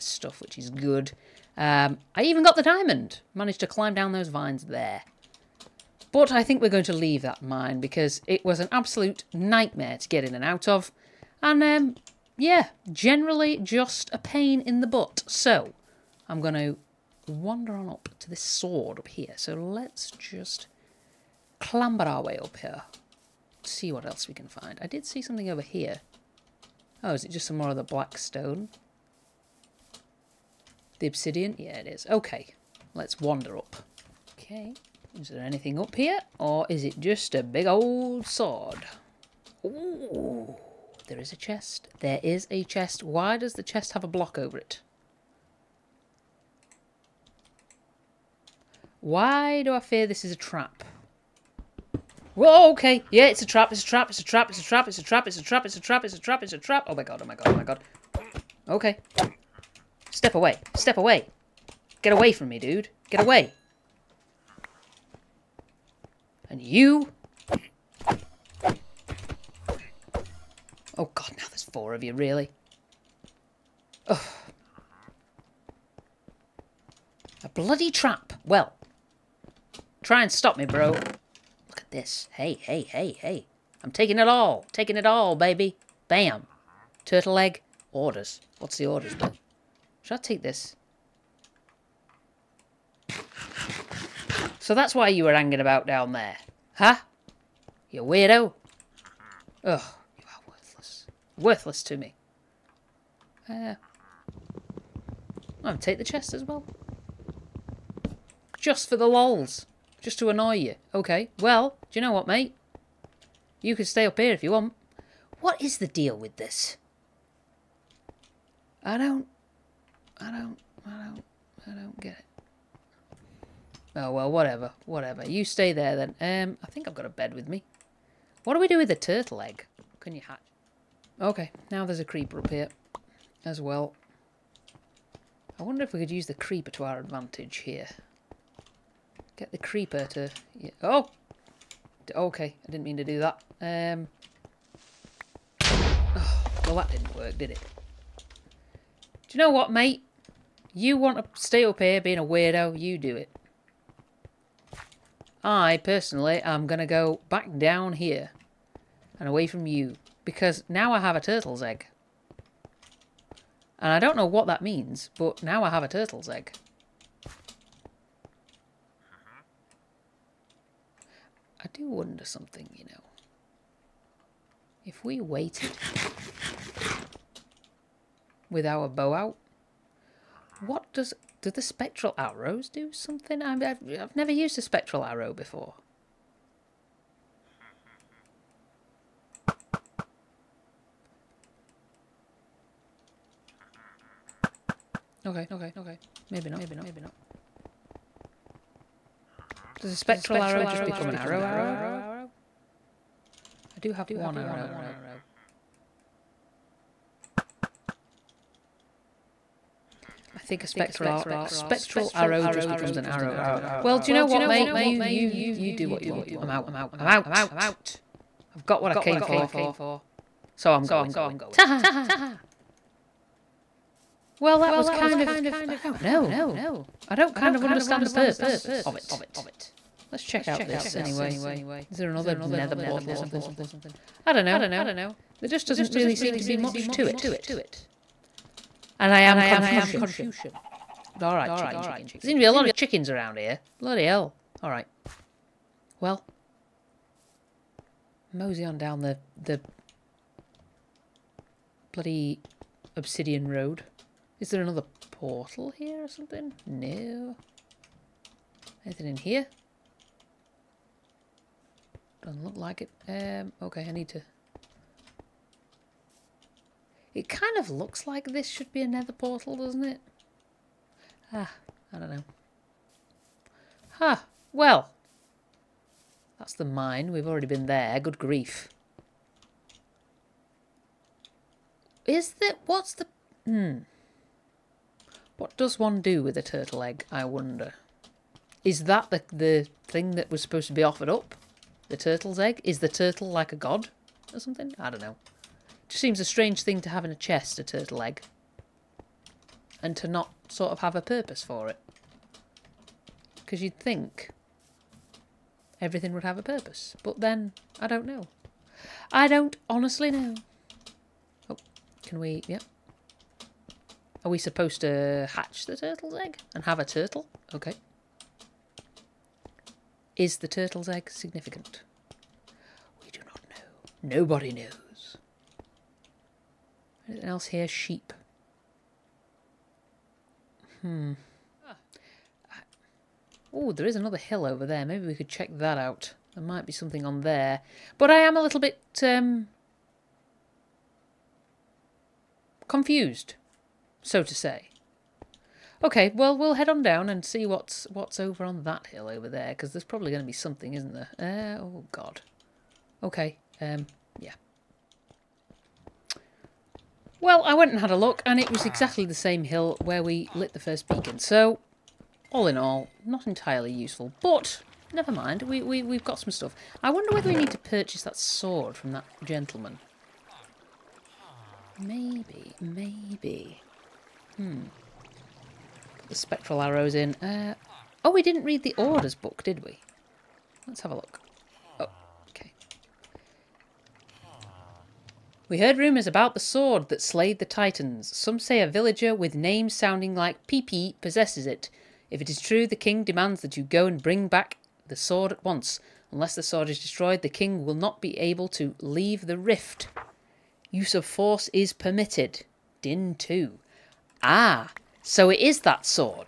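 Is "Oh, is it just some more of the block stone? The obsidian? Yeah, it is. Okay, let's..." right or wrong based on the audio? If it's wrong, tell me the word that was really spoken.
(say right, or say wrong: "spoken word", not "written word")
wrong: "black", not "block".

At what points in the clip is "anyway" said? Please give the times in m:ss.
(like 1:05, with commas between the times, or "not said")
3:50.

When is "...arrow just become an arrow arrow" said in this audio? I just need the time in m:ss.
3:20.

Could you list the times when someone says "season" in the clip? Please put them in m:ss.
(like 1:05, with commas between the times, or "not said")
not said.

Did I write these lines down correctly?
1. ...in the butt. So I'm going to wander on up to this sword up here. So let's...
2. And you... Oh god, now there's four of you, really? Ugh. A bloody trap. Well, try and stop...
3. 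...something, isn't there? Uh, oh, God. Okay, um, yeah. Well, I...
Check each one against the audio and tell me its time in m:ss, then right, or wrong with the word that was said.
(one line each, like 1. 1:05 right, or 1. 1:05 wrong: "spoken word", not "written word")
1. 0:14 right
2. 1:06 right
3. 5:50 right.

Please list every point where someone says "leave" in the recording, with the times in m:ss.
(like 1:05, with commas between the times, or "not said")
0:06, 6:38.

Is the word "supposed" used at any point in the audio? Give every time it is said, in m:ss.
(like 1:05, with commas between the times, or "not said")
4:50, 5:14.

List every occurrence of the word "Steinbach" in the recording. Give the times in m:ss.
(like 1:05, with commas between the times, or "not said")
not said.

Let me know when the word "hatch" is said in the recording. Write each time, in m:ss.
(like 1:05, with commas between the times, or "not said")
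2:10, 5:15.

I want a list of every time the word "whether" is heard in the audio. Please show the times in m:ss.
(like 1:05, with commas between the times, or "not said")
6:07.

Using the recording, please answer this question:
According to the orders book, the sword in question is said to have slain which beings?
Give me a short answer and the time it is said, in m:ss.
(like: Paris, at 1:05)
Titans, at 6:27.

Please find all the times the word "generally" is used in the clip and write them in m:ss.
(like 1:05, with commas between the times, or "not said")
0:12.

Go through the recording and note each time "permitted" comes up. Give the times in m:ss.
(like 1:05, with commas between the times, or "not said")
6:41.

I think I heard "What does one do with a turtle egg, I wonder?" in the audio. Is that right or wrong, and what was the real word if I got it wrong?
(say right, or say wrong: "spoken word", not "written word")
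right.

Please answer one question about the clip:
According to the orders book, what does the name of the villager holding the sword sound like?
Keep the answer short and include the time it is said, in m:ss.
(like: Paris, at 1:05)
Pee-Pee, at 6:30.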